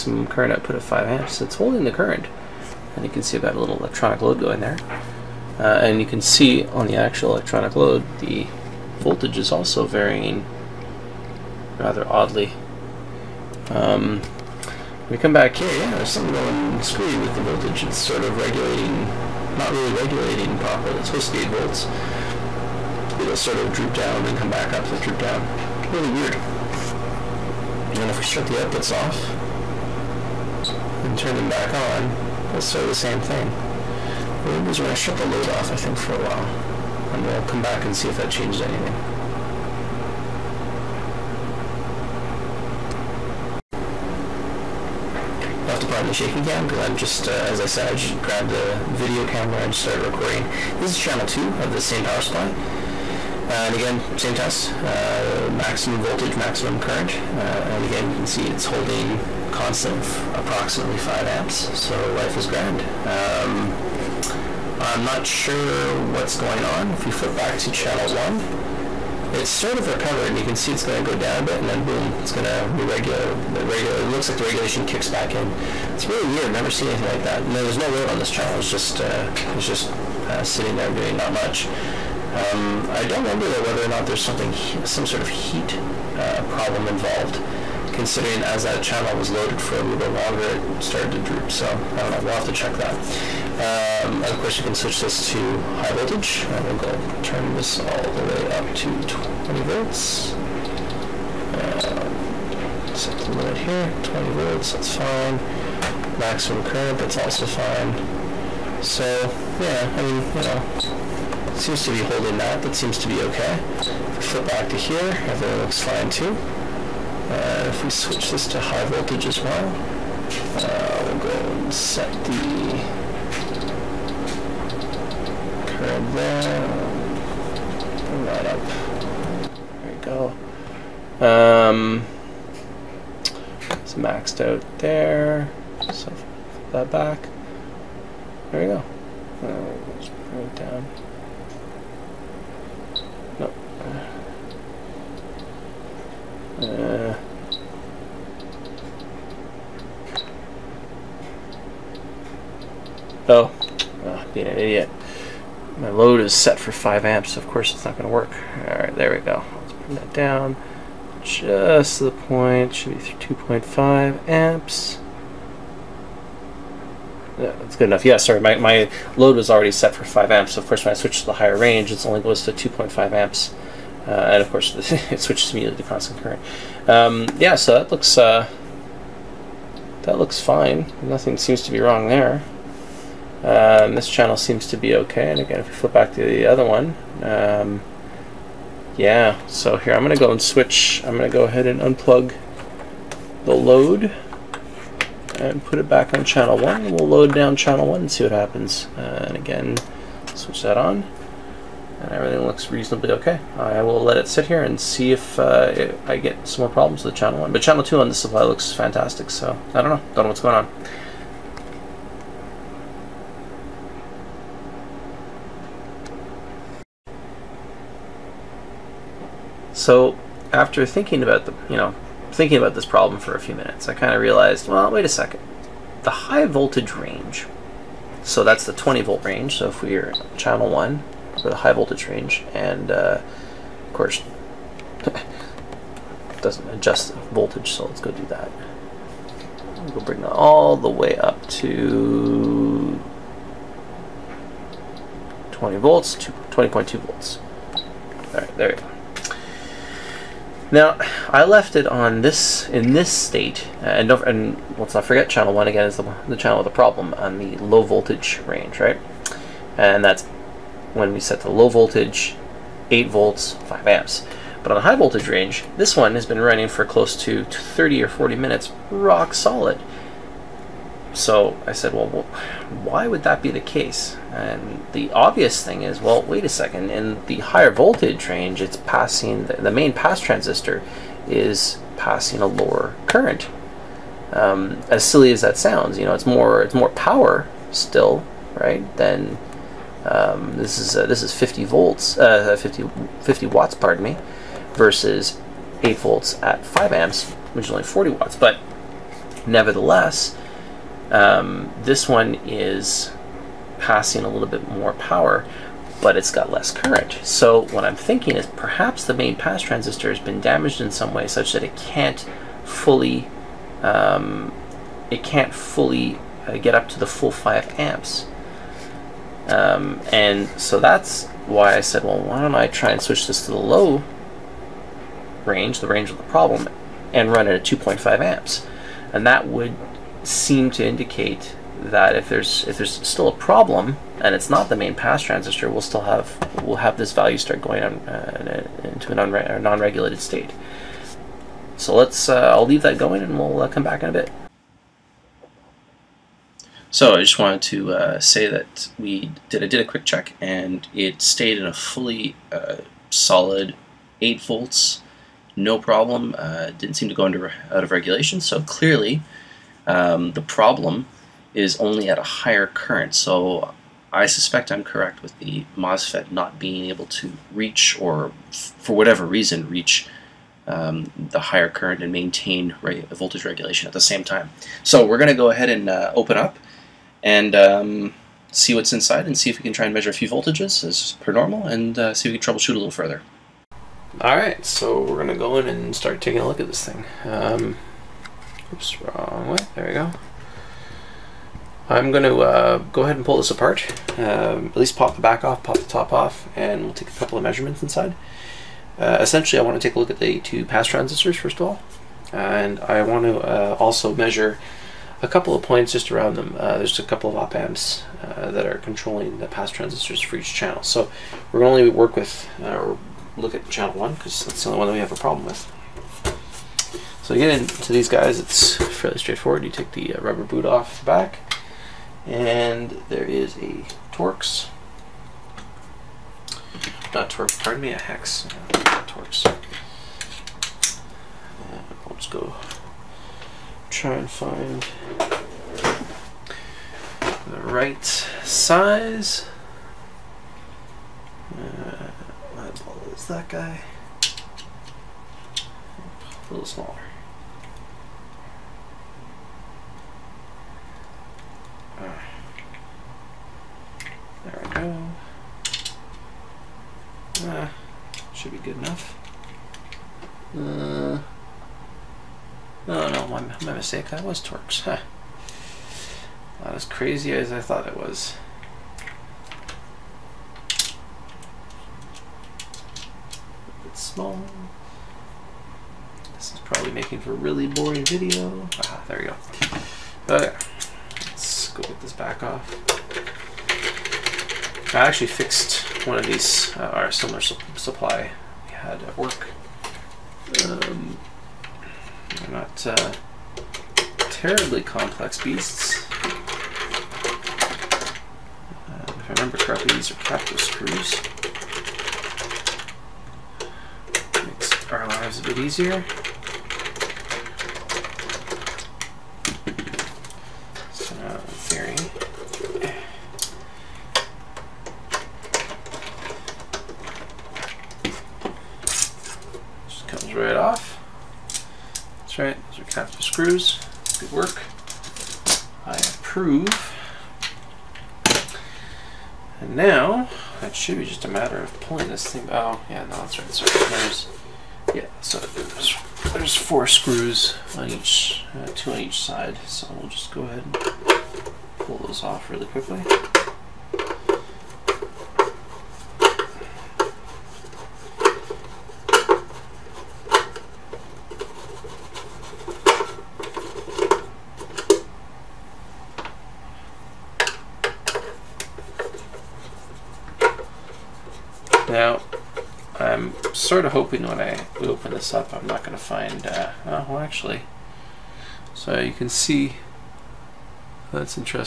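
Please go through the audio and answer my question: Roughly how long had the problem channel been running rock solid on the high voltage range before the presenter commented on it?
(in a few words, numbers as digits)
30 or 40 minutes.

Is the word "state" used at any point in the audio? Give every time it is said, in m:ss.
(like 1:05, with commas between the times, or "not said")
4:13, 5:40.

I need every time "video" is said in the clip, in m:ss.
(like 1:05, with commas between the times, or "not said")
0:48, 7:58.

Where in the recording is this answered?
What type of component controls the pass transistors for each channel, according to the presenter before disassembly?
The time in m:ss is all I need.
6:46.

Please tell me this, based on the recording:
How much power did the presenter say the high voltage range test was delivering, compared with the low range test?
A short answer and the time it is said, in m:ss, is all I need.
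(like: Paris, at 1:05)
50 watts, at 4:53.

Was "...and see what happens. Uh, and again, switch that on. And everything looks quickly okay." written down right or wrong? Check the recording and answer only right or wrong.
wrong.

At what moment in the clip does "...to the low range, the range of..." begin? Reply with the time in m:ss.
5:23.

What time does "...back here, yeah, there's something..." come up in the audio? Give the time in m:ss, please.
0:15.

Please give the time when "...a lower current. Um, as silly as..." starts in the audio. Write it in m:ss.
4:42.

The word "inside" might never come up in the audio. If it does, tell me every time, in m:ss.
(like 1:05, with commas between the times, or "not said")
6:18, 6:37.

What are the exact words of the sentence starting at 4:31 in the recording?
So I said, well, why would that be the case?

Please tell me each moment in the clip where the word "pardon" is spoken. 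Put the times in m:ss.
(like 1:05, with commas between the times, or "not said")
4:53, 7:07.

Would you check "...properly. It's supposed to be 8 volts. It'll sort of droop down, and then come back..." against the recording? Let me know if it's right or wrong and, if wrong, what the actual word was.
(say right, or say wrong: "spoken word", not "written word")
right.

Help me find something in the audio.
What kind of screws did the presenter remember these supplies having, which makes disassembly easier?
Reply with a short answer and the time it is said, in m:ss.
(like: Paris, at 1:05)
captive screws, at 8:19.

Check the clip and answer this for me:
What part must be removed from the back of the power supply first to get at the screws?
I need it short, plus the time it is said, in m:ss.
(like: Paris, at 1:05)
rubber boot, at 6:59.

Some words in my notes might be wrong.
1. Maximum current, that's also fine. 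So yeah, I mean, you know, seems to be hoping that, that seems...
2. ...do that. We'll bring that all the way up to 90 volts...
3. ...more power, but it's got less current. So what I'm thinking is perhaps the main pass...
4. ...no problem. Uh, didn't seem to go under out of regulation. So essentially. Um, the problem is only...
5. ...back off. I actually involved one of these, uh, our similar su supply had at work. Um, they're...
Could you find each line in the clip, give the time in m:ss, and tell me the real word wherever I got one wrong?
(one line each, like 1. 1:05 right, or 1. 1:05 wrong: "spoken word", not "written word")
1. 1:46 wrong: "holding", not "hoping"
2. 3:58 wrong: "20", not "90"
3. 5:04 right
4. 5:55 wrong: "clearly", not "essentially"
5. 8:02 wrong: "fixed", not "involved".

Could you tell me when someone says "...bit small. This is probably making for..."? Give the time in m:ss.
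7:53.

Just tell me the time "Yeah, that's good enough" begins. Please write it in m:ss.
2:47.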